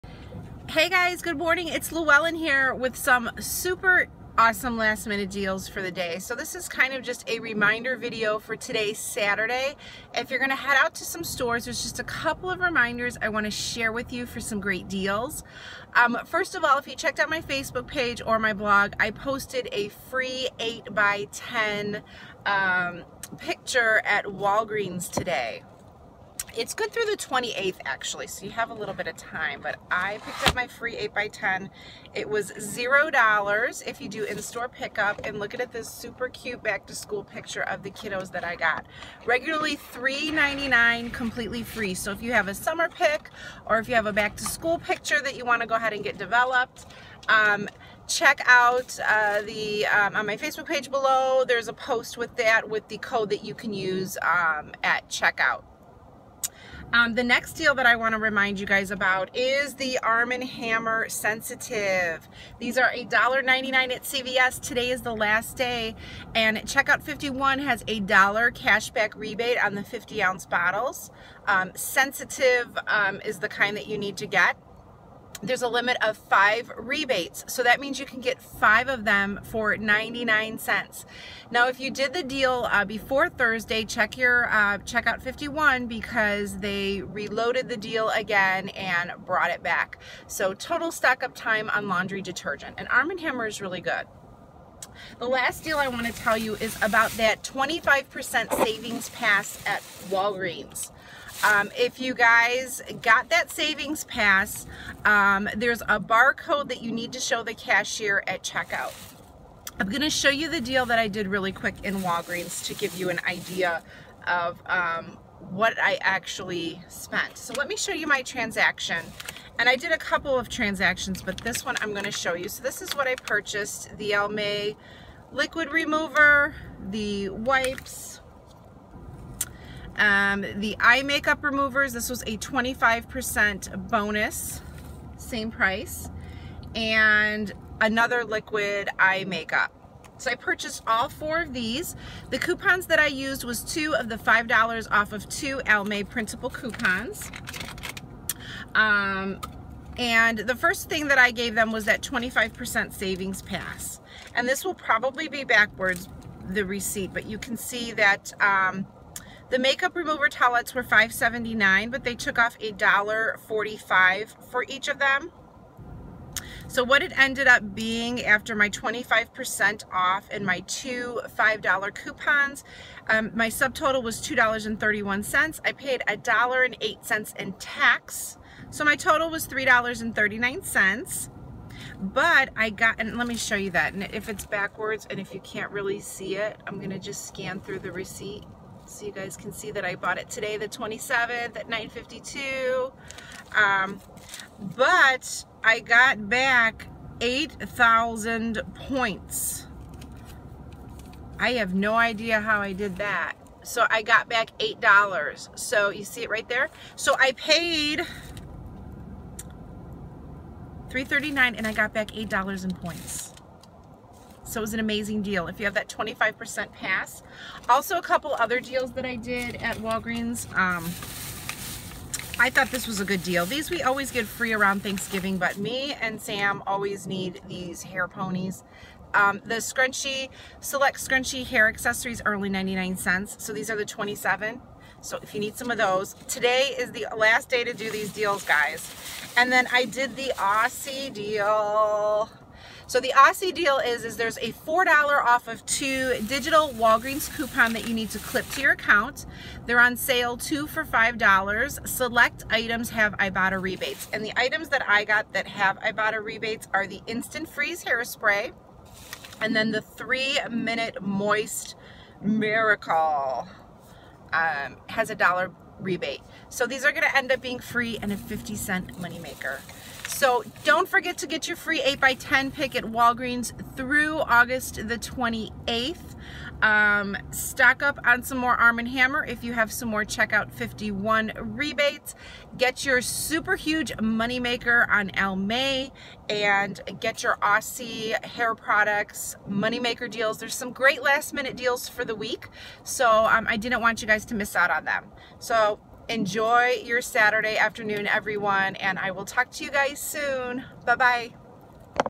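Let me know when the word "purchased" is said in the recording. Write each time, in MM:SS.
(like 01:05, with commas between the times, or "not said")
02:03, 02:20.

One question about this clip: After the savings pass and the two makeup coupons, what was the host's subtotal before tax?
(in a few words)
$2.31.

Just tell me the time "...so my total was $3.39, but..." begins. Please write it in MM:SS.
02:58.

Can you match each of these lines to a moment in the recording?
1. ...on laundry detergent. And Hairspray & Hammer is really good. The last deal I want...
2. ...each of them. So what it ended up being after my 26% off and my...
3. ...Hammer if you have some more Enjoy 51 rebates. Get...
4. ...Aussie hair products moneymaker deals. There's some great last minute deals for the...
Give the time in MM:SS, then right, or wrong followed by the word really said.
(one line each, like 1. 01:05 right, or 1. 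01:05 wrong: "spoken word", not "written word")
1. 01:31 wrong: "Arm", not "Hairspray"
2. 02:44 wrong: "25", not "26"
3. 04:38 wrong: "Checkout", not "Enjoy"
4. 04:47 right.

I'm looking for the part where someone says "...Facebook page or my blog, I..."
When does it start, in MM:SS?
00:17.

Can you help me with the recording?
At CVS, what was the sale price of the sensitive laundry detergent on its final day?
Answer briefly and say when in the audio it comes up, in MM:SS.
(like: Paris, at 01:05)
$1.99, at 01:02.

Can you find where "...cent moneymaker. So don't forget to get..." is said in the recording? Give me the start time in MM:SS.
04:28.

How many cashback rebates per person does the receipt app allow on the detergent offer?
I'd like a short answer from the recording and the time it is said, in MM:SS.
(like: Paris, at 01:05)
5, at 01:15.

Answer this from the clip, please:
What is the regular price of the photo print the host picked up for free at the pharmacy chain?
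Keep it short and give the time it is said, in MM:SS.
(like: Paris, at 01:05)
$3.99, at 00:39.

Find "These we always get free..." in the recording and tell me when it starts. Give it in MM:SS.
03:43.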